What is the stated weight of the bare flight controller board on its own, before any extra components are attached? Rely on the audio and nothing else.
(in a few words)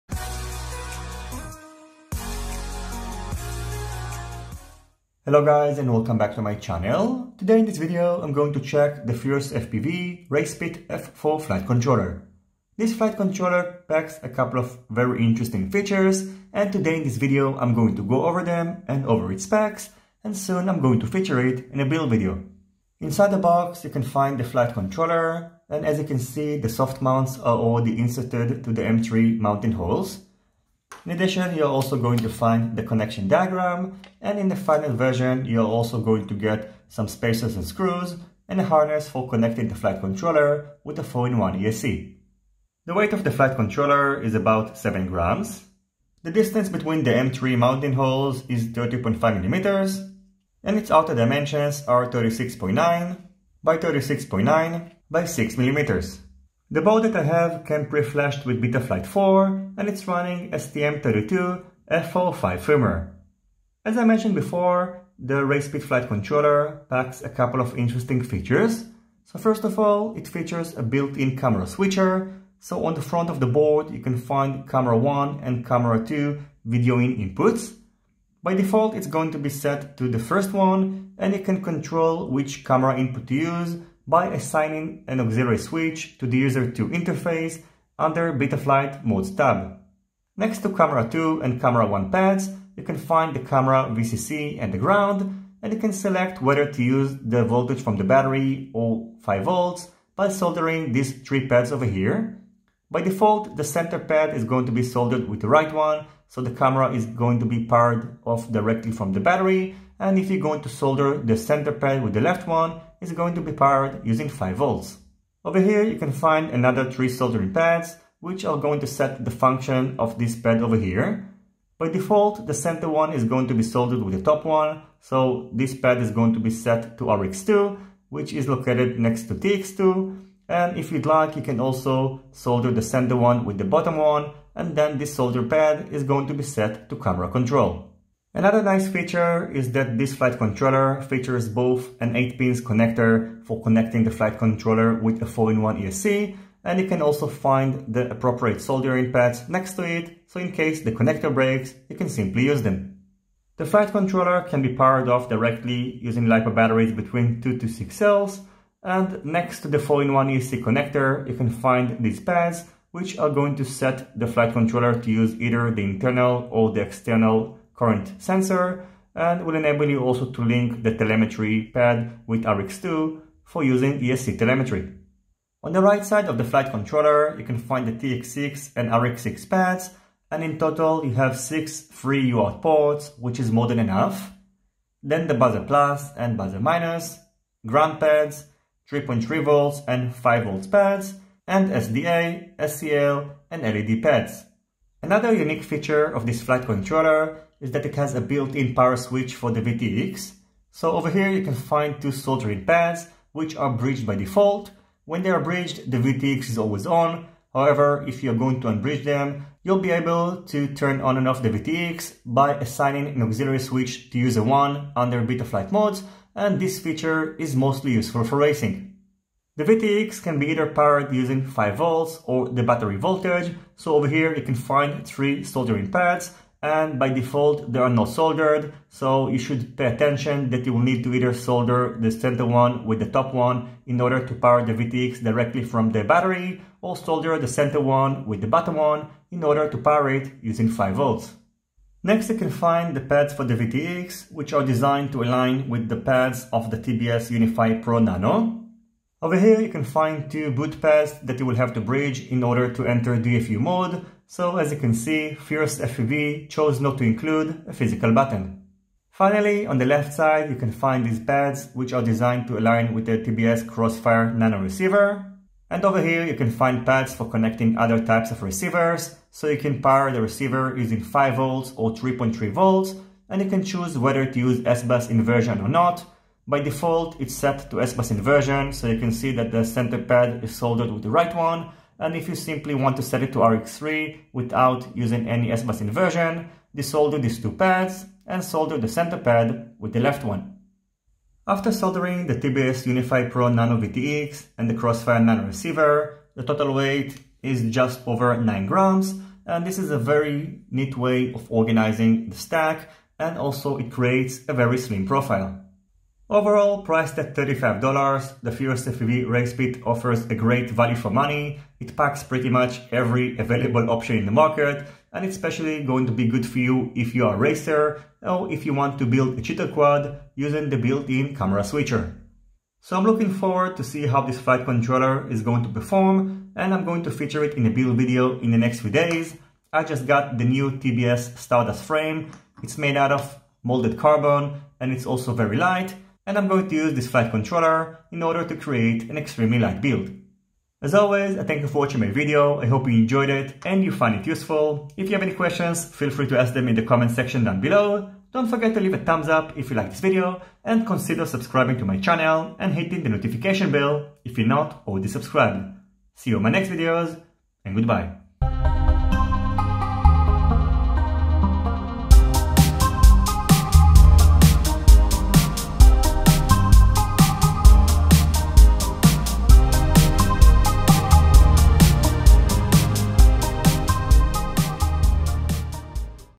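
7 grams.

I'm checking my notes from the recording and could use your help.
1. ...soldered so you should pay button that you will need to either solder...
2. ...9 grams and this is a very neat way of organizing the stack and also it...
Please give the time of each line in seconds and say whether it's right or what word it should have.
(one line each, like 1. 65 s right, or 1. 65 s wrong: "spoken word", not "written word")
1. 228 s wrong: "attention", not "button"
2. 298 s right.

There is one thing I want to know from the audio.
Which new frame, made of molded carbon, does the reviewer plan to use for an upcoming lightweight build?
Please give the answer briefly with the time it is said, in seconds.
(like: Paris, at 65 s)
TBS Stardust, at 330 s.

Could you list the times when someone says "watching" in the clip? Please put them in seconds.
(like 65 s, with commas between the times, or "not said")
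341 s.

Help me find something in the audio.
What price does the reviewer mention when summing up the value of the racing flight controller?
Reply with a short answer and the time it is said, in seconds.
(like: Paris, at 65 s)
$35, at 307 s.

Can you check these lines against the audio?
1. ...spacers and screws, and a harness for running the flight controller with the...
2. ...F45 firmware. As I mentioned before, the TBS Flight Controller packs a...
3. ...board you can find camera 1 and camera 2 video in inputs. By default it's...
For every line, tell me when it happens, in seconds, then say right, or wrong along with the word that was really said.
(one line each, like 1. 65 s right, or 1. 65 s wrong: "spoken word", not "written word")
1. 37 s wrong: "connecting", not "running"
2. 61 s wrong: "RacePit", not "TBS"
3. 73 s right.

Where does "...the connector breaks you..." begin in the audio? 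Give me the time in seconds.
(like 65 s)
150 s.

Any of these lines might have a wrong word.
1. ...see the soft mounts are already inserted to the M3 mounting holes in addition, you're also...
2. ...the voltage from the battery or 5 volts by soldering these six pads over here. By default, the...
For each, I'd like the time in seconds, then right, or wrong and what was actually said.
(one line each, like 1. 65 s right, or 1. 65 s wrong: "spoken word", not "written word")
1. 26 s right
2. 97 s wrong: "three", not "six".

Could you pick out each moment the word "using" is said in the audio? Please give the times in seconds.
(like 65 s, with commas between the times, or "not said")
114 s, 156 s, 173 s, 221 s, 240 s, 270 s, 284 s, 320 s.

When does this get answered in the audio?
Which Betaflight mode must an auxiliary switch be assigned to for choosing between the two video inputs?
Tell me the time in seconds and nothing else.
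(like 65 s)
86 s.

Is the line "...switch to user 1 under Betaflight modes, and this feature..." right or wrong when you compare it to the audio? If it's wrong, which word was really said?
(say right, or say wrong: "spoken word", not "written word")
right.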